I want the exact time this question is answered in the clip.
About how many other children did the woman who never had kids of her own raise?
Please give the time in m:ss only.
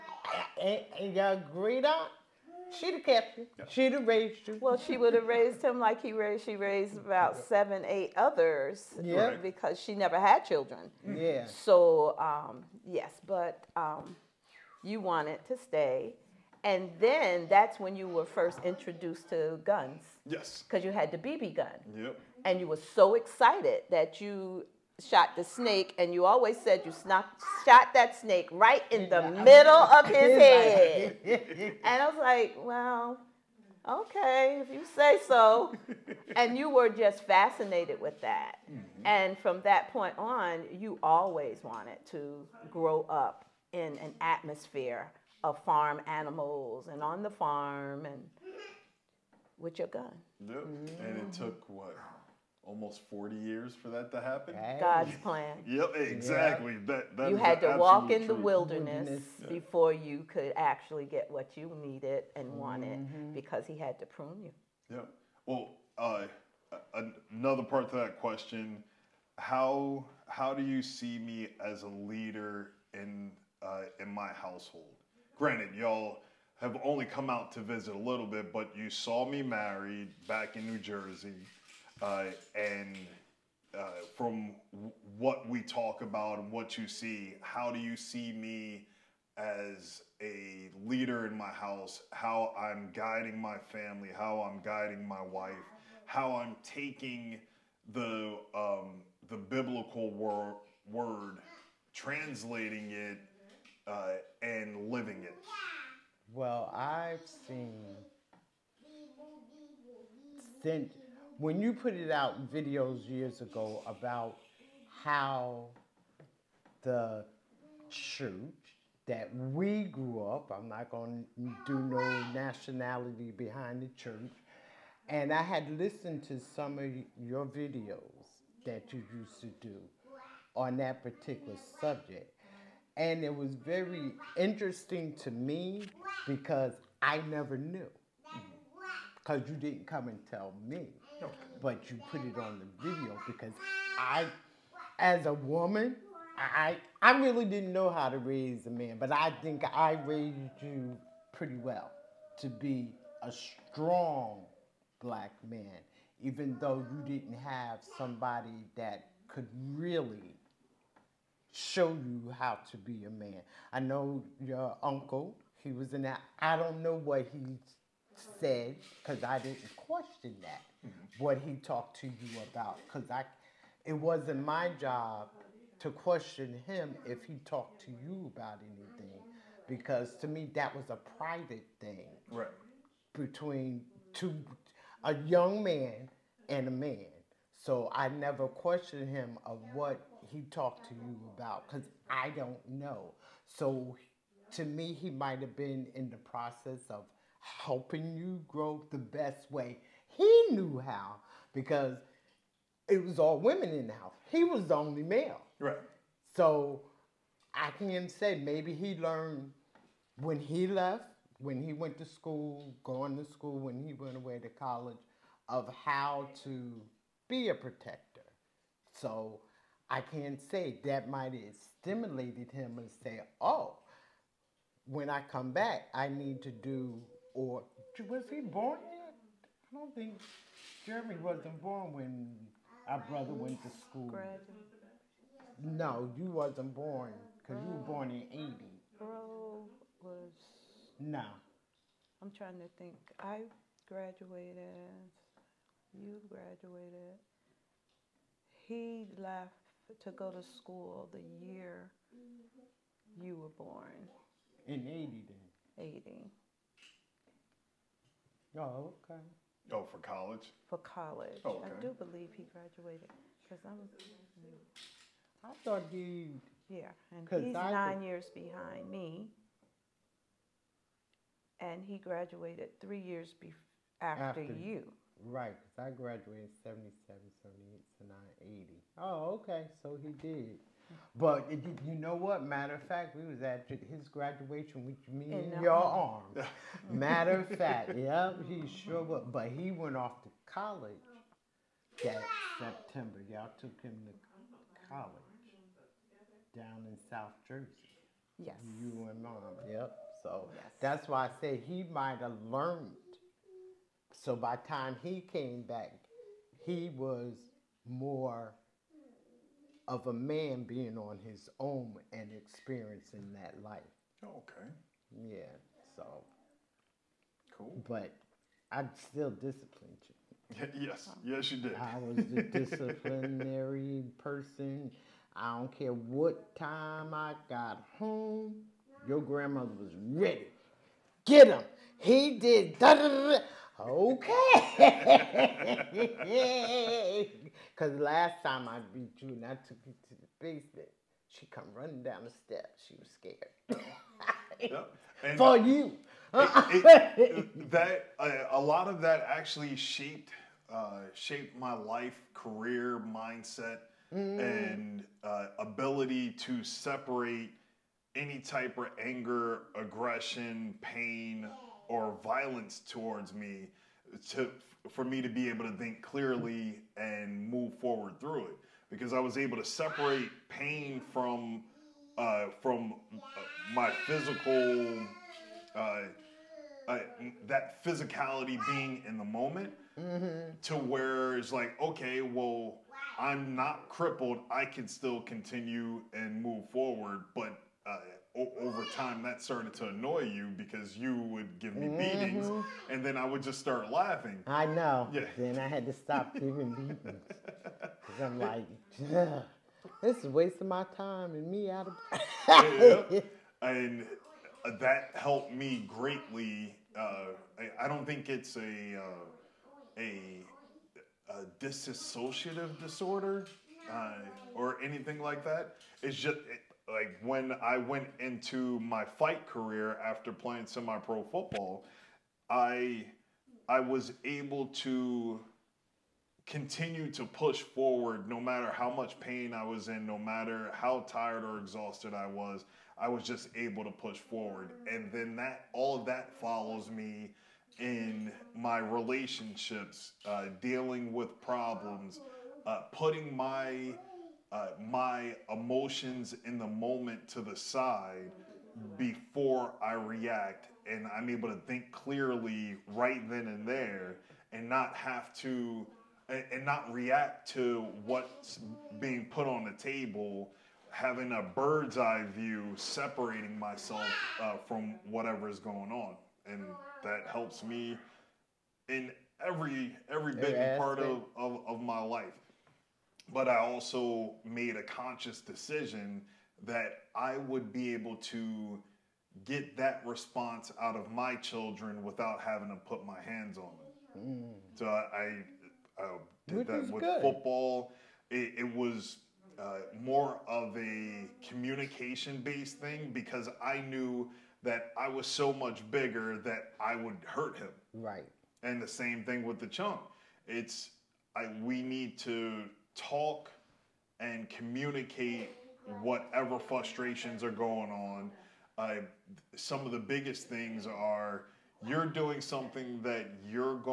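0:07.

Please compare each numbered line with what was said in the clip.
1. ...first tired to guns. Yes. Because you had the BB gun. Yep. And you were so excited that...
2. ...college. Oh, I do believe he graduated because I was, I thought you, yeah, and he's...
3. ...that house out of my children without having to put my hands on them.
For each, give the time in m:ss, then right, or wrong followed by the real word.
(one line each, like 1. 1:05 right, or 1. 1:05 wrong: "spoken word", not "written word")
1. 0:18 wrong: "introduced", not "tired"
2. 4:20 right
3. 7:59 wrong: "response", not "house".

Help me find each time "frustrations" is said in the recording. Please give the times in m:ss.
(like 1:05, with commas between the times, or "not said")
8:26.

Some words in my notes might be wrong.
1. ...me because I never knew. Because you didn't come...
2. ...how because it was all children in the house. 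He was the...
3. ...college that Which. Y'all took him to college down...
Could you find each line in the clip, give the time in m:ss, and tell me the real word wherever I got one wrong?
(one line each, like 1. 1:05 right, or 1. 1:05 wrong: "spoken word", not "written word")
1. 2:15 right
2. 3:20 wrong: "women", not "children"
3. 4:50 wrong: "September", not "Which".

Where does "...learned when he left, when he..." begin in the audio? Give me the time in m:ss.
3:28.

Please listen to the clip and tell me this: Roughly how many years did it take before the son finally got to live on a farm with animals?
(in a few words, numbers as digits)
40.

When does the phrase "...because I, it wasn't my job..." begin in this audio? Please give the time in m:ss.
2:52.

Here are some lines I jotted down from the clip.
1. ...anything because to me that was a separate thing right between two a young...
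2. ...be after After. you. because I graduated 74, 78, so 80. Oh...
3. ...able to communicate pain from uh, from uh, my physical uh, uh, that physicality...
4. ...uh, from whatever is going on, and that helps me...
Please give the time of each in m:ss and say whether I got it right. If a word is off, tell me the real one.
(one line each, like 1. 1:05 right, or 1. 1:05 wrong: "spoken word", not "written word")
1. 2:58 wrong: "private", not "separate"
2. 4:33 wrong: "77", not "74"
3. 6:09 wrong: "separate", not "communicate"
4. 7:44 right.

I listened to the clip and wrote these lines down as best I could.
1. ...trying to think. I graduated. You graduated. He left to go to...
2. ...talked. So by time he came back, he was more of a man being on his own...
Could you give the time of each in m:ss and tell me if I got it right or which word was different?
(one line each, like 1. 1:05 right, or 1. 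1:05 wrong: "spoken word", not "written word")
1. 4:02 right
2. 5:02 wrong: "learned", not "talked".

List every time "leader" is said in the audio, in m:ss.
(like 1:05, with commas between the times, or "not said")
1:11, 1:30.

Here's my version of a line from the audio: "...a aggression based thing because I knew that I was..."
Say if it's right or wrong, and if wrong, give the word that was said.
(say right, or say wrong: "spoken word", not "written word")
wrong: "communication", not "aggression".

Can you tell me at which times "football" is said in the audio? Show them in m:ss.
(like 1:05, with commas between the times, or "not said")
7:01, 8:07.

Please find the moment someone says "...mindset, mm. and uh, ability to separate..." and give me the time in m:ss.
5:53.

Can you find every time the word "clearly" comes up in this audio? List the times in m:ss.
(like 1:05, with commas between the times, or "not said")
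6:06, 7:31.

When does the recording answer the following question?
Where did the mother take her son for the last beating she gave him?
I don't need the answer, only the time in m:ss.
5:40.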